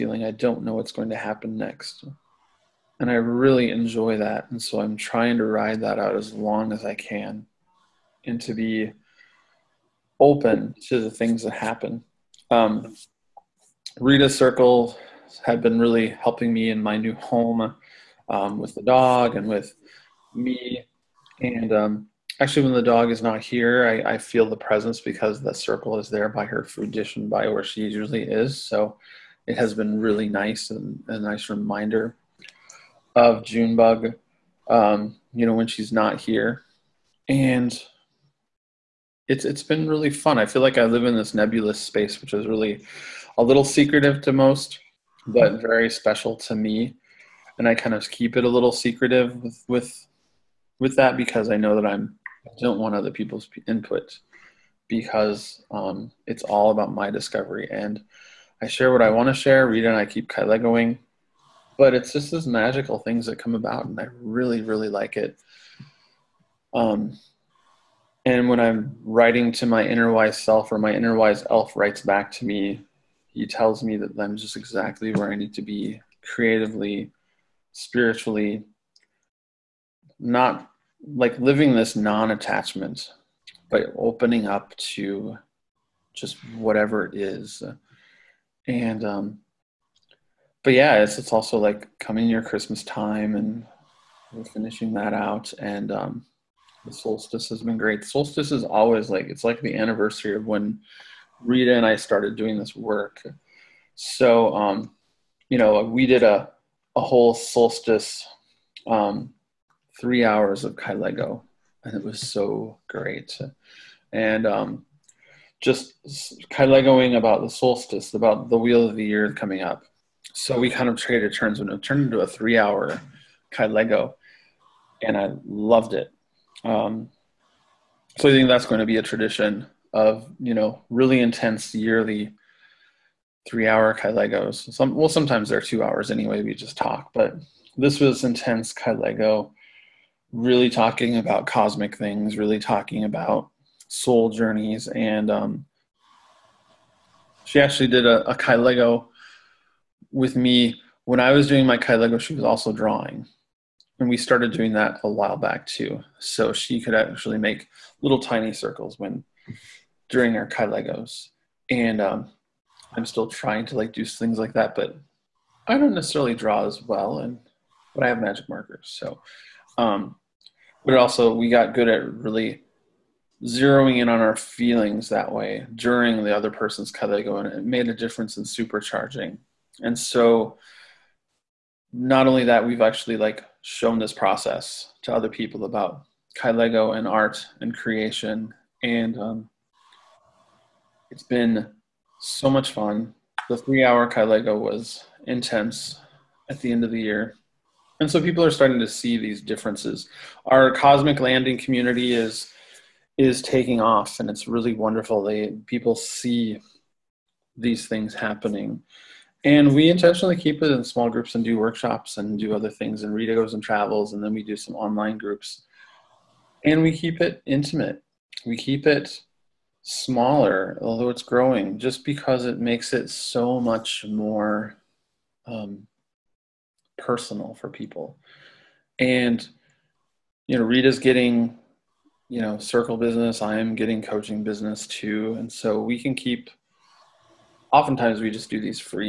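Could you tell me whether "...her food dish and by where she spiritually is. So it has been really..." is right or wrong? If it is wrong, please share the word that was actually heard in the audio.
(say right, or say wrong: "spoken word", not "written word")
wrong: "usually", not "spiritually".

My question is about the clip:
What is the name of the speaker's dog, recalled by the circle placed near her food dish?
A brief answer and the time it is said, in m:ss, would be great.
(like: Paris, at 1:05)
Junebug, at 0:33.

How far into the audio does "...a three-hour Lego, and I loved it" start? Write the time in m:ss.
2:02.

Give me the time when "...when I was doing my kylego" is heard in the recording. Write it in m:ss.
2:31.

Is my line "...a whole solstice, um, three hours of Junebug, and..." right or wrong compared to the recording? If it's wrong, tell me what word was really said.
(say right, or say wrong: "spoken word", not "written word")
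wrong: "Lego", not "Junebug".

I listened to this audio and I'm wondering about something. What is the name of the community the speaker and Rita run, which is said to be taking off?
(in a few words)
Cosmic Landing.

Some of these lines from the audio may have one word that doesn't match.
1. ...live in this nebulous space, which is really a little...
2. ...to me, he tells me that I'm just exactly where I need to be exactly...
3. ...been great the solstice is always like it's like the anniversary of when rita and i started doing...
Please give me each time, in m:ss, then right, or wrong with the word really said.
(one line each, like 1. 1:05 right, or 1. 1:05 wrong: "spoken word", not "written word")
1. 0:40 right
2. 1:12 wrong: "creatively", not "exactly"
3. 1:37 right.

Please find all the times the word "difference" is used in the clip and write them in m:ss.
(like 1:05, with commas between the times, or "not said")
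2:57, 3:19.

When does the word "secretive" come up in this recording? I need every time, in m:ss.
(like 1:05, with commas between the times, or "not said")
0:43, 0:48.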